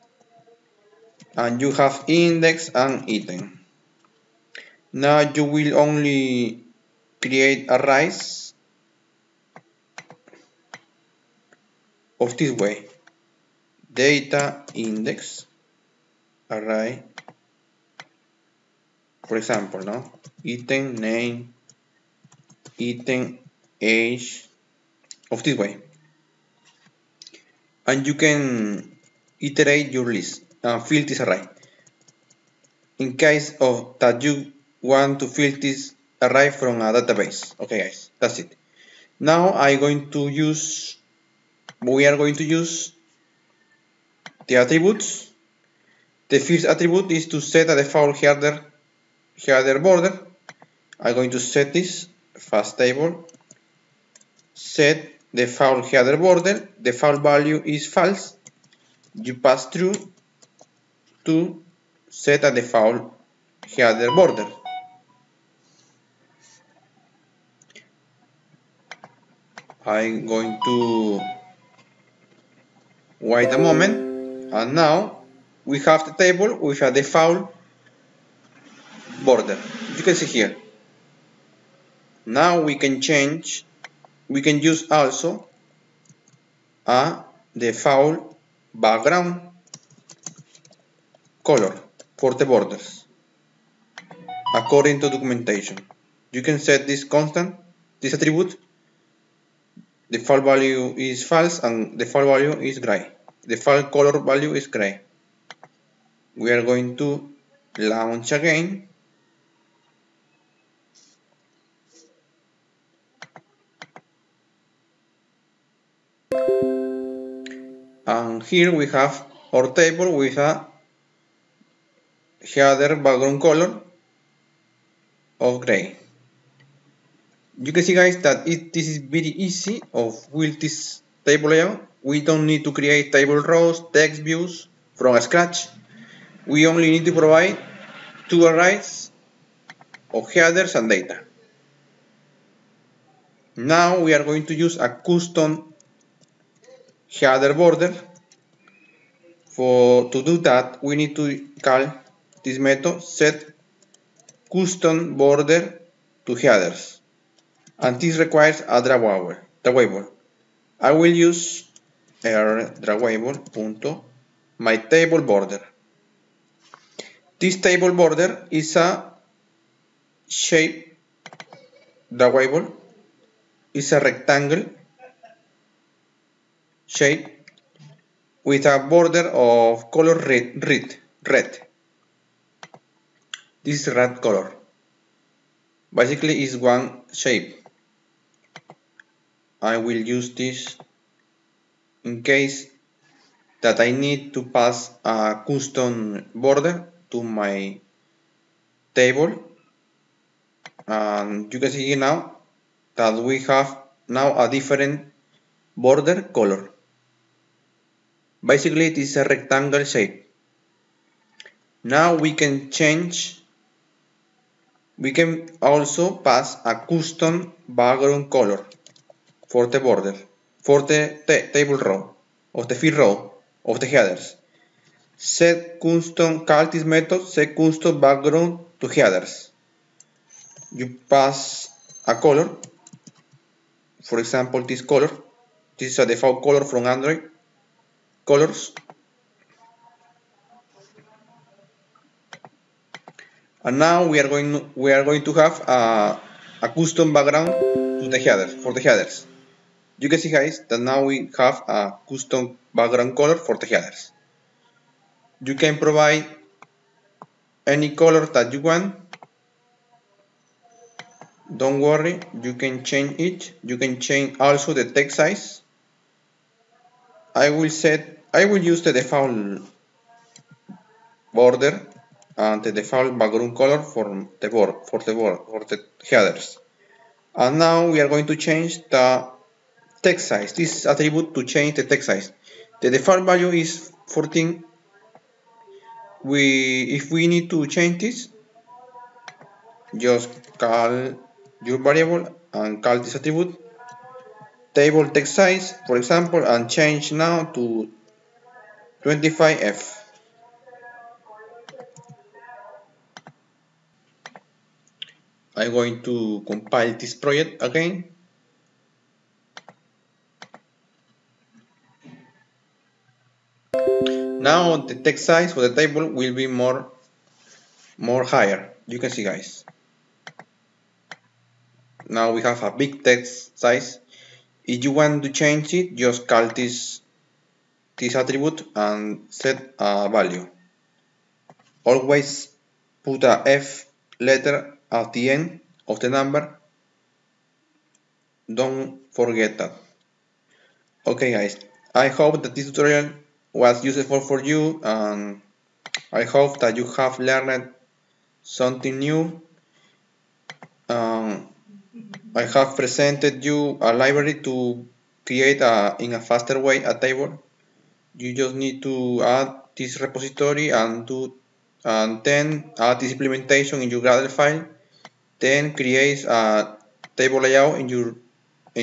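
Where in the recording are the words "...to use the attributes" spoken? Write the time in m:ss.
0:42.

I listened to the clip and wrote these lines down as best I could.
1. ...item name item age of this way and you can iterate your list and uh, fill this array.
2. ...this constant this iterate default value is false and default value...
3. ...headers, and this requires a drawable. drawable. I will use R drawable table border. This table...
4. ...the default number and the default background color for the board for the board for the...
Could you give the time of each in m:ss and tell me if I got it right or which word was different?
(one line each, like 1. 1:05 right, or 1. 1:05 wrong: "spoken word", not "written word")
1. 0:20 right
2. 1:36 wrong: "attribute", not "iterate"
3. 2:36 right
4. 4:28 wrong: "border", not "number".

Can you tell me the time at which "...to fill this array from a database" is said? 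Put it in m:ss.
0:35.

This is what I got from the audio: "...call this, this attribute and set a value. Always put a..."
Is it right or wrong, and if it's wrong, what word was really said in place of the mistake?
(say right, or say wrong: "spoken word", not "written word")
right.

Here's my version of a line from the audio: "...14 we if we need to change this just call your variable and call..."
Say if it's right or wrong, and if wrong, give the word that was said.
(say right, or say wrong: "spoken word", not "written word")
right.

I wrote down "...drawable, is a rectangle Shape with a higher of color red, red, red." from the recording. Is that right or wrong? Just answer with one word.
wrong.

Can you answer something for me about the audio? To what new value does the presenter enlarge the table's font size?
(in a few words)
25F.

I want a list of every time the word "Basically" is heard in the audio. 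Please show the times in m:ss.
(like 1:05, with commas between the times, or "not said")
3:05, 3:28.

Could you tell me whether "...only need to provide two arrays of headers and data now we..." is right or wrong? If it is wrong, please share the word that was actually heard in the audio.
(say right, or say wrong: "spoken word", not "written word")
right.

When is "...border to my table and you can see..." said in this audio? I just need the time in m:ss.
3:16.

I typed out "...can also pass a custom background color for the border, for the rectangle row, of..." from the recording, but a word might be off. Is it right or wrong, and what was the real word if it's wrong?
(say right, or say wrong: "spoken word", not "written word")
wrong: "table", not "rectangle".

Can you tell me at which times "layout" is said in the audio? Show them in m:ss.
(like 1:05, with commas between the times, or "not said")
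2:11, 6:07.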